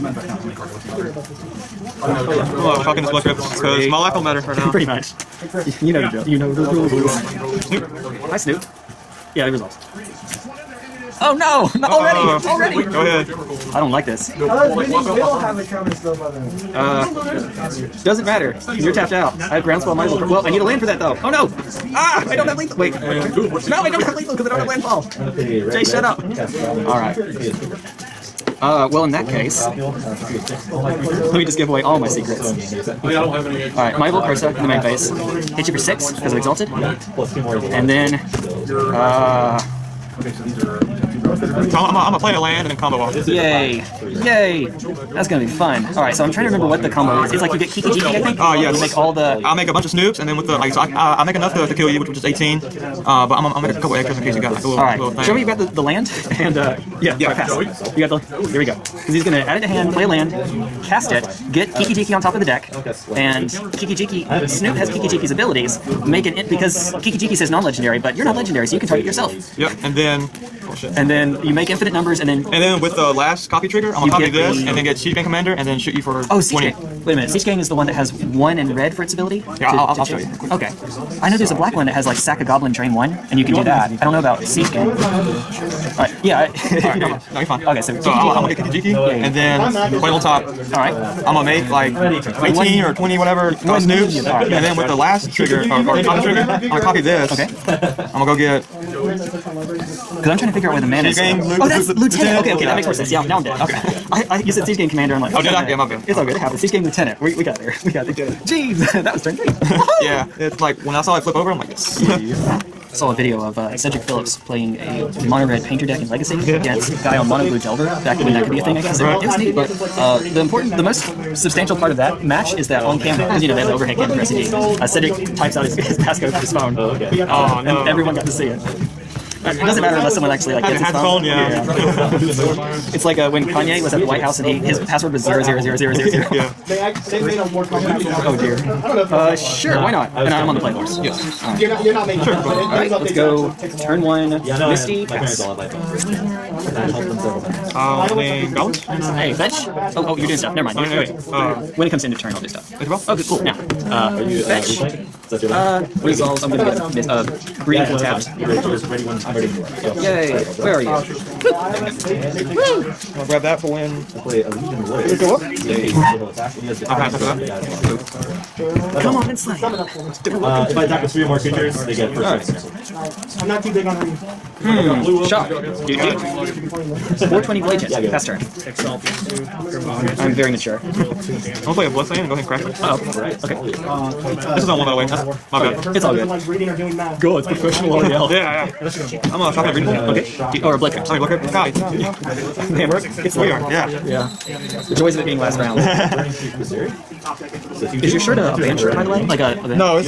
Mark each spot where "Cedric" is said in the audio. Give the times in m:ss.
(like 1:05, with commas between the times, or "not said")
1:53, 2:04.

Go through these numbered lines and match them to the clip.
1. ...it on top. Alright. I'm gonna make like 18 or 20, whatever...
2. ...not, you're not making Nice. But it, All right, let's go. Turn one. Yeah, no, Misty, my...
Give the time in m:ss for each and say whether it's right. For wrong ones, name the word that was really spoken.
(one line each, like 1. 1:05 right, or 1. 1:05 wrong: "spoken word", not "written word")
1. 1:30 right
2. 2:21 wrong: "Sure", not "Nice".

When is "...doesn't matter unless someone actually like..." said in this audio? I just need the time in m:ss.
2:09.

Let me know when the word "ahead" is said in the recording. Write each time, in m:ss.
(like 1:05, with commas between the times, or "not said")
0:13, 3:02.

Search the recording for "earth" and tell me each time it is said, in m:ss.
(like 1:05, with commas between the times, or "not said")
not said.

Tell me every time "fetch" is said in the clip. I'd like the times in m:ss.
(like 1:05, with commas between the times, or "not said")
2:29, 2:34.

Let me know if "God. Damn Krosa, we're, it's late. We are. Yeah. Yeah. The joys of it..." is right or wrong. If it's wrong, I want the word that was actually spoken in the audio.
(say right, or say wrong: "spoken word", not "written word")
wrong: "Man", not "Krosa".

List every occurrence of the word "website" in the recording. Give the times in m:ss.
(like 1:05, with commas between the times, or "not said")
not said.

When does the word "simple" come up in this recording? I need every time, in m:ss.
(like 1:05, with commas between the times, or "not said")
not said.